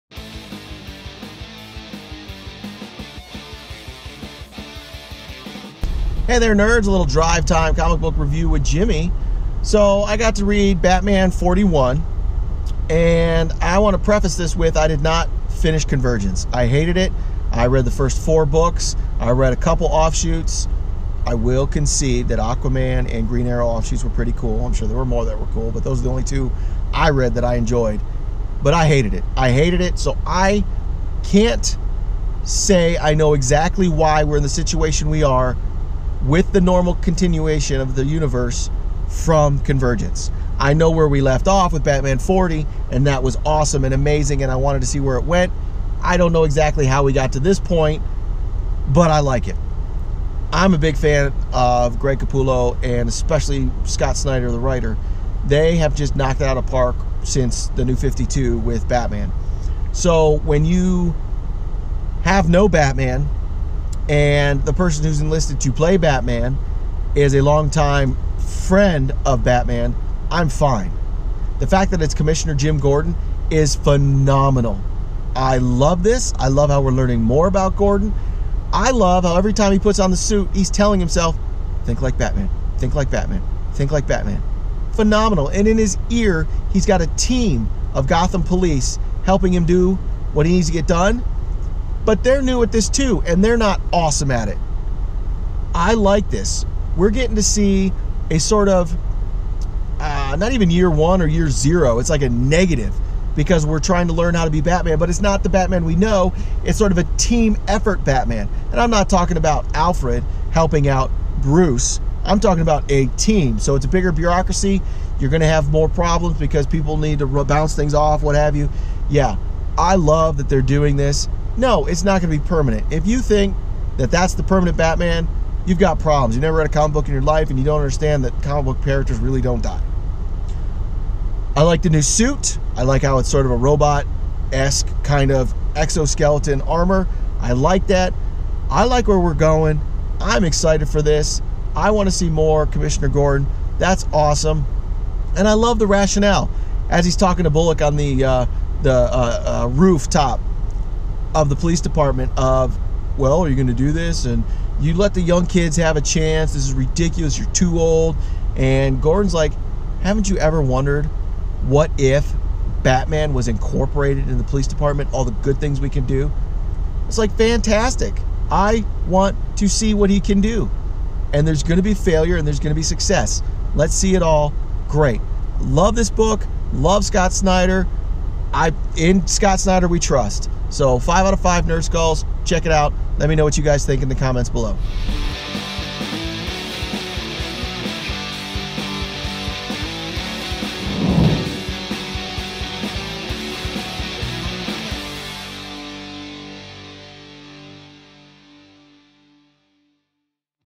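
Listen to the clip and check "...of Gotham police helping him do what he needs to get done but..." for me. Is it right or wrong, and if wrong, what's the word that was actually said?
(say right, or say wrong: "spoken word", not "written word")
right.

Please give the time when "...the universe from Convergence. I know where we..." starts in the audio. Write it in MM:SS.
00:37.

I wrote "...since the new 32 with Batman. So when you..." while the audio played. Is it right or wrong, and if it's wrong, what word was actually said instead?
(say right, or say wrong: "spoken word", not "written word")
wrong: "52", not "32".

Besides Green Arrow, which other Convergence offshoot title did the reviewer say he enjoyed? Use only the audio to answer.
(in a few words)
Aquaman.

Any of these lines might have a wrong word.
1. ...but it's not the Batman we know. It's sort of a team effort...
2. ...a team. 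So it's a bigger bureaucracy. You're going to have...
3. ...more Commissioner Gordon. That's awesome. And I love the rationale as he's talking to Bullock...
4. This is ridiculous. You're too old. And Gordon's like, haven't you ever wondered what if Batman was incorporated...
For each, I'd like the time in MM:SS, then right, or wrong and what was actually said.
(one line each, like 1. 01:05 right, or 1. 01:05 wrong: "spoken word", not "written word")
1. 01:44 right
2. 01:52 right
3. 02:22 right
4. 02:36 right.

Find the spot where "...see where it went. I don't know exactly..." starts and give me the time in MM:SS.
00:44.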